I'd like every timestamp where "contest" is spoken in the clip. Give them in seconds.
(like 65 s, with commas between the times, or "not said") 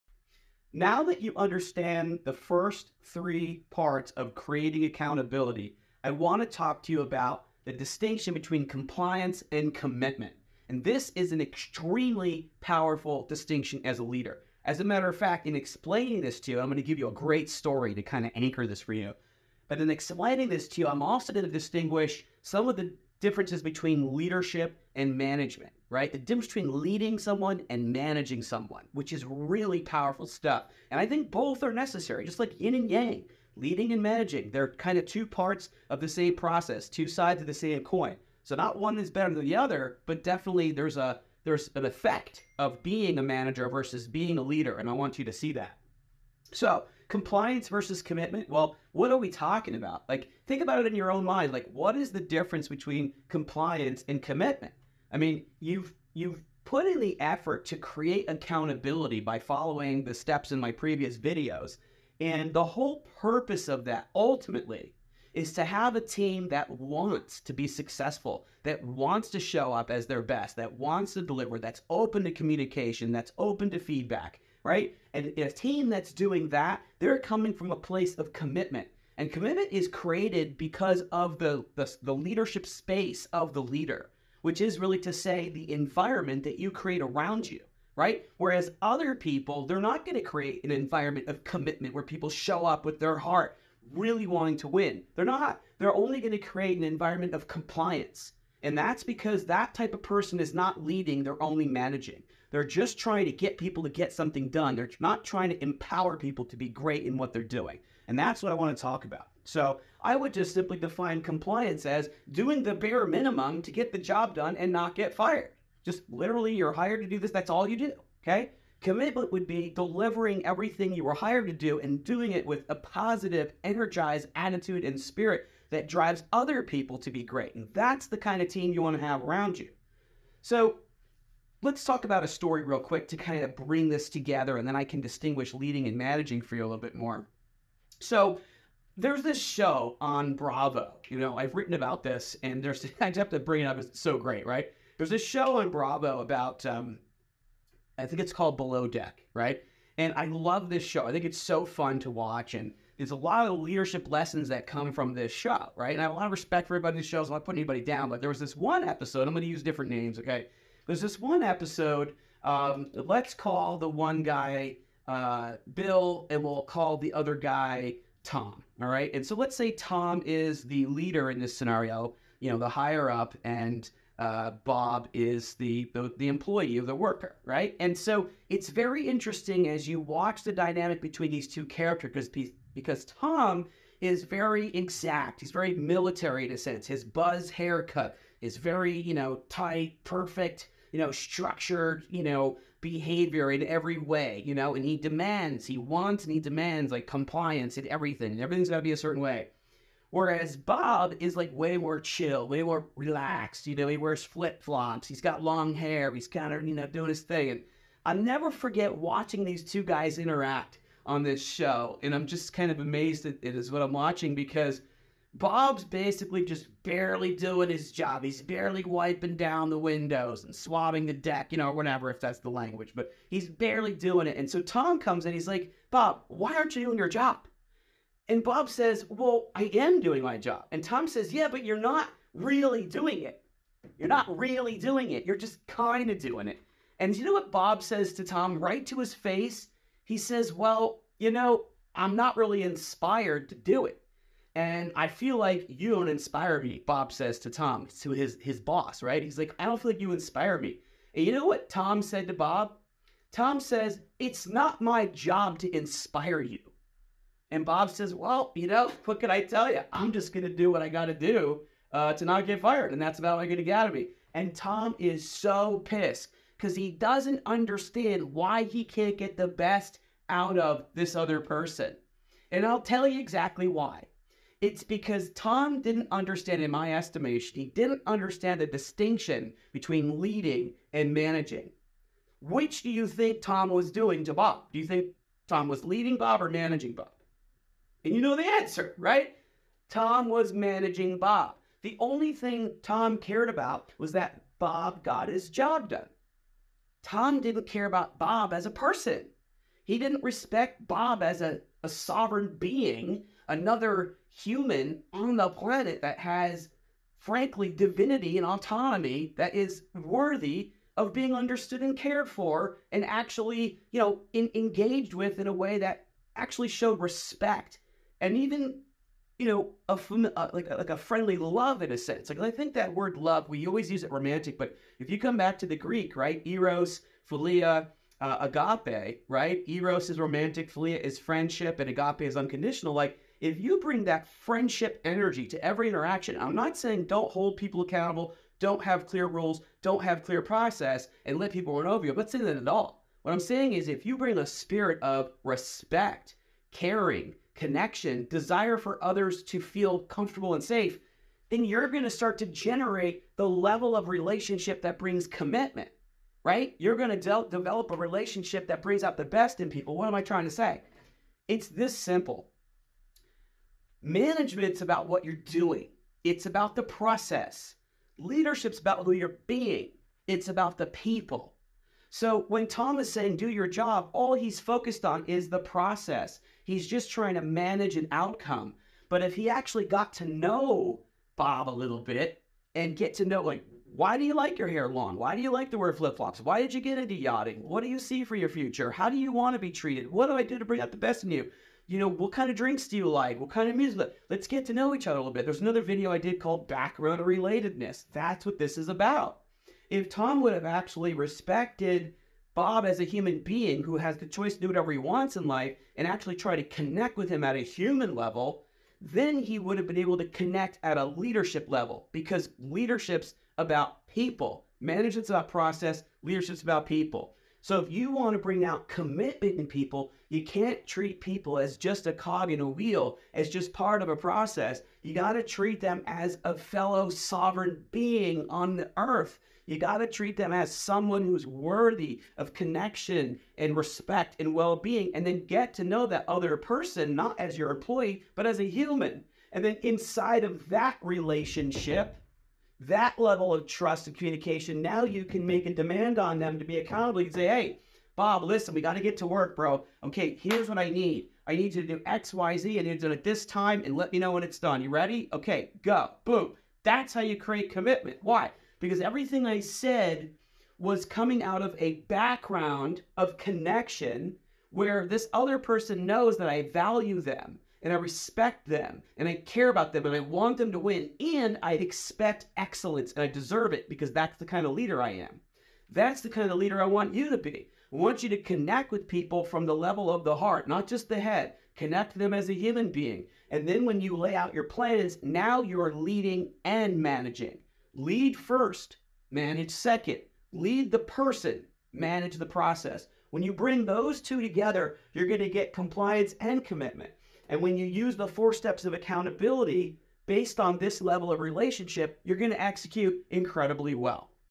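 not said.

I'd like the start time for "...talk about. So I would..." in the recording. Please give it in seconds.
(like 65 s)
108 s.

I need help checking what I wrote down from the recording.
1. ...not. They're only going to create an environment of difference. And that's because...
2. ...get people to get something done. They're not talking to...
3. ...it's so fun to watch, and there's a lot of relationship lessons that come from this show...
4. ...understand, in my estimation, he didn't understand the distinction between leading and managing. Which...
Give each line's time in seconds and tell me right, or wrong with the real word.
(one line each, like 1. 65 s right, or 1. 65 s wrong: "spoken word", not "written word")
1. 95 s wrong: "compliance", not "difference"
2. 103 s wrong: "trying", not "talking"
3. 151 s wrong: "leadership", not "relationship"
4. 276 s right.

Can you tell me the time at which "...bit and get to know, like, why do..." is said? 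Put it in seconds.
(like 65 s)
382 s.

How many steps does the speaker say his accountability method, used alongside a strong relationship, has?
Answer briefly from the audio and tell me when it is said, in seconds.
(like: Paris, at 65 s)
4, at 498 s.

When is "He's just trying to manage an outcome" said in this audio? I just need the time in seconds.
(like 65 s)
376 s.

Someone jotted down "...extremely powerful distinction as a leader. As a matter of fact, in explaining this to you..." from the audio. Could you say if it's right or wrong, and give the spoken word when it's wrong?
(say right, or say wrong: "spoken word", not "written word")
right.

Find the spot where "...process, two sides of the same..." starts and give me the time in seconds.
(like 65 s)
36 s.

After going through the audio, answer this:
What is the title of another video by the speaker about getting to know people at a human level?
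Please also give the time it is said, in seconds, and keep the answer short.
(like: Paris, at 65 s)
Background Relatedness, at 396 s.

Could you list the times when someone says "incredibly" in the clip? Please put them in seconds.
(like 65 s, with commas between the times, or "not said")
503 s.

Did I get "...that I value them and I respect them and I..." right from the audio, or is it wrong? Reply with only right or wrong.
right.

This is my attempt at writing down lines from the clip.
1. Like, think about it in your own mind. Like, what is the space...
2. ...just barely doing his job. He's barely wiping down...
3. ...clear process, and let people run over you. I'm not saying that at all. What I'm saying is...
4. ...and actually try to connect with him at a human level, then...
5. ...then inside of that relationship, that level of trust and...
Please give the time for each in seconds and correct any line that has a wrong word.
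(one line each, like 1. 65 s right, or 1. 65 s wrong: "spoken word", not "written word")
1. 50 s wrong: "difference", not "space"
2. 216 s right
3. 340 s right
4. 405 s right
5. 439 s right.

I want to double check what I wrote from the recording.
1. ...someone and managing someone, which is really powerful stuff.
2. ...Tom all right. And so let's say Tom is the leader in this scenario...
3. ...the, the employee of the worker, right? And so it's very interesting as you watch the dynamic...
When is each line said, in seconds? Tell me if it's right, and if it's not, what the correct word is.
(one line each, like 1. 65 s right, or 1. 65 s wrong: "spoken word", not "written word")
1. 27 s right
2. 168 s right
3. 175 s right.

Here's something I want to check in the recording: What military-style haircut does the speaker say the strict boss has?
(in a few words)
buzz haircut.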